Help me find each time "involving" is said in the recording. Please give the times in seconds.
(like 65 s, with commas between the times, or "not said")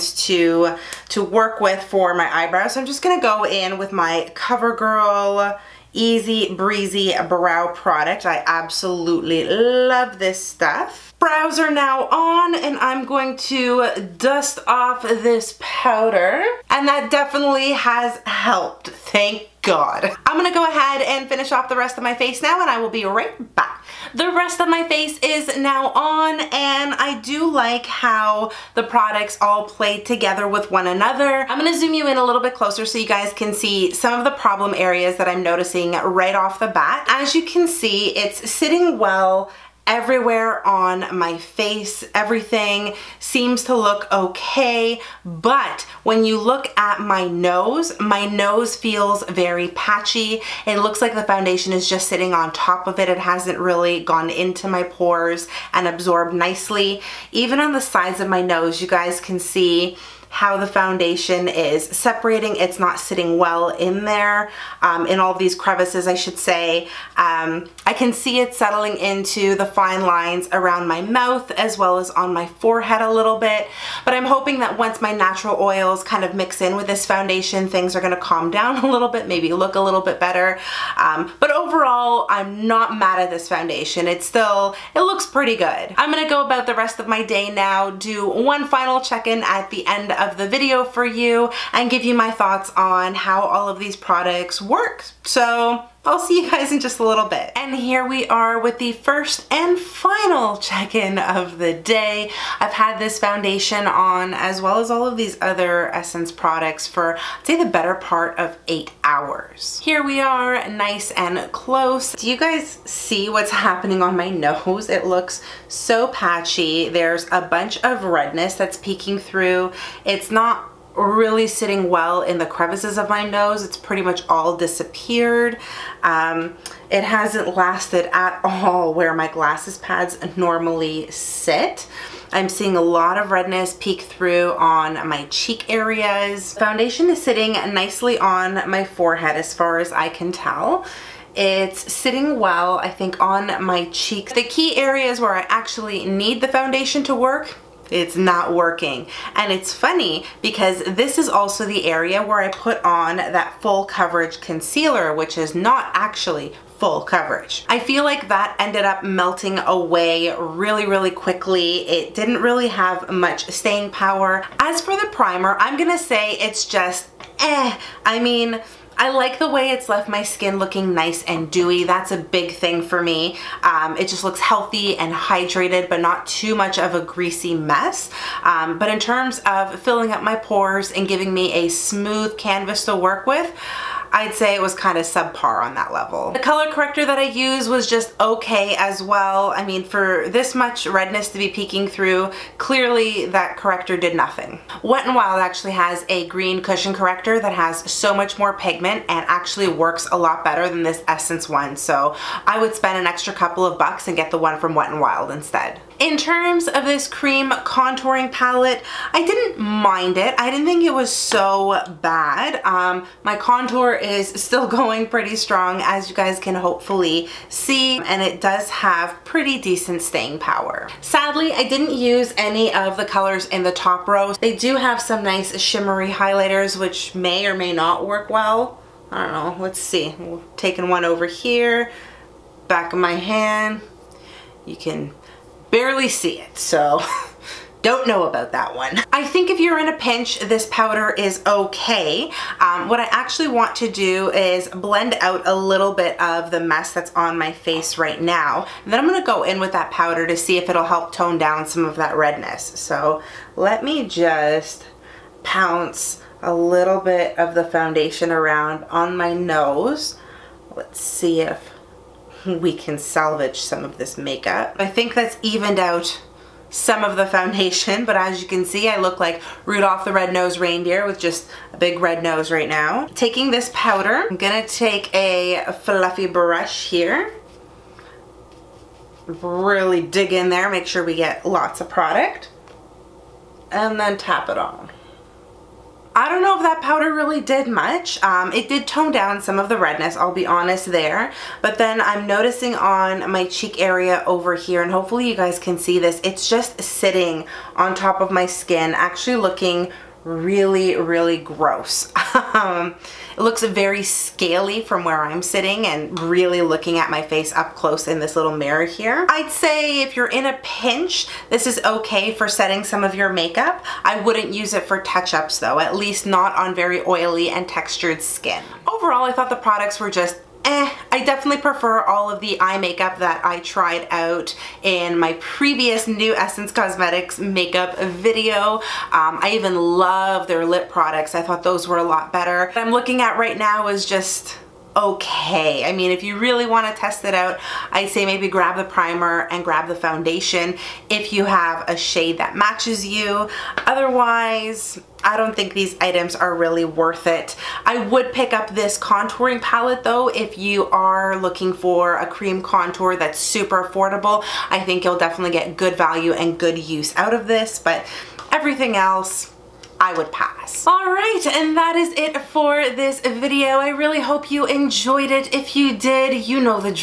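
not said.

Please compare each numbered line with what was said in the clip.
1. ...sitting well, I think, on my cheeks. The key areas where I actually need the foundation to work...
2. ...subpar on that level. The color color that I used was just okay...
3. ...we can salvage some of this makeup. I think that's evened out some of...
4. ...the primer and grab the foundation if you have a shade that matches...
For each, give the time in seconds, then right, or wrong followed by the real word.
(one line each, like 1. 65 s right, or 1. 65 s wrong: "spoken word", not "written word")
1. 141 s right
2. 185 s wrong: "corrector", not "color"
3. 262 s right
4. 338 s right.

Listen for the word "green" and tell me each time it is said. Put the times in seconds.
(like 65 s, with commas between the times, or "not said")
196 s.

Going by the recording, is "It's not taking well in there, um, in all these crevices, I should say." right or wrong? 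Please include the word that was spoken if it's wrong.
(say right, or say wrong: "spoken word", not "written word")
wrong: "sitting", not "taking".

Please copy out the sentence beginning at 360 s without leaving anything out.
All right, and that is it for this video.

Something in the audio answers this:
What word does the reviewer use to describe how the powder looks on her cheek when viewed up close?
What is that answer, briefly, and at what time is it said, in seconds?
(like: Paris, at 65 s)
scaly, at 304 s.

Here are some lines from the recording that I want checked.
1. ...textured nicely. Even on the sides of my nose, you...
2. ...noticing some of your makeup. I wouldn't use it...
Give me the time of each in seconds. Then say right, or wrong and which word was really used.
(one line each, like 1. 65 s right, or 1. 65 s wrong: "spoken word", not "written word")
1. 55 s wrong: "absorbed", not "textured"
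2. 312 s wrong: "setting", not "noticing".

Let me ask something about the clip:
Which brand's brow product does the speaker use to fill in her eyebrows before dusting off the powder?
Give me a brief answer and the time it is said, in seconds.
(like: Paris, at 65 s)
CoverGirl, at 4 s.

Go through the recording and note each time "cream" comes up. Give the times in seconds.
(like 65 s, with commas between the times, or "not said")
207 s, 352 s.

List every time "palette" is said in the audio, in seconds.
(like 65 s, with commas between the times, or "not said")
208 s, 349 s.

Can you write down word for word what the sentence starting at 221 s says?
Sadly, I didn't use any of the colors in the top row.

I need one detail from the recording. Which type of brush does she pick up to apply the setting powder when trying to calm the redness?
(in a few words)
fluffy brush.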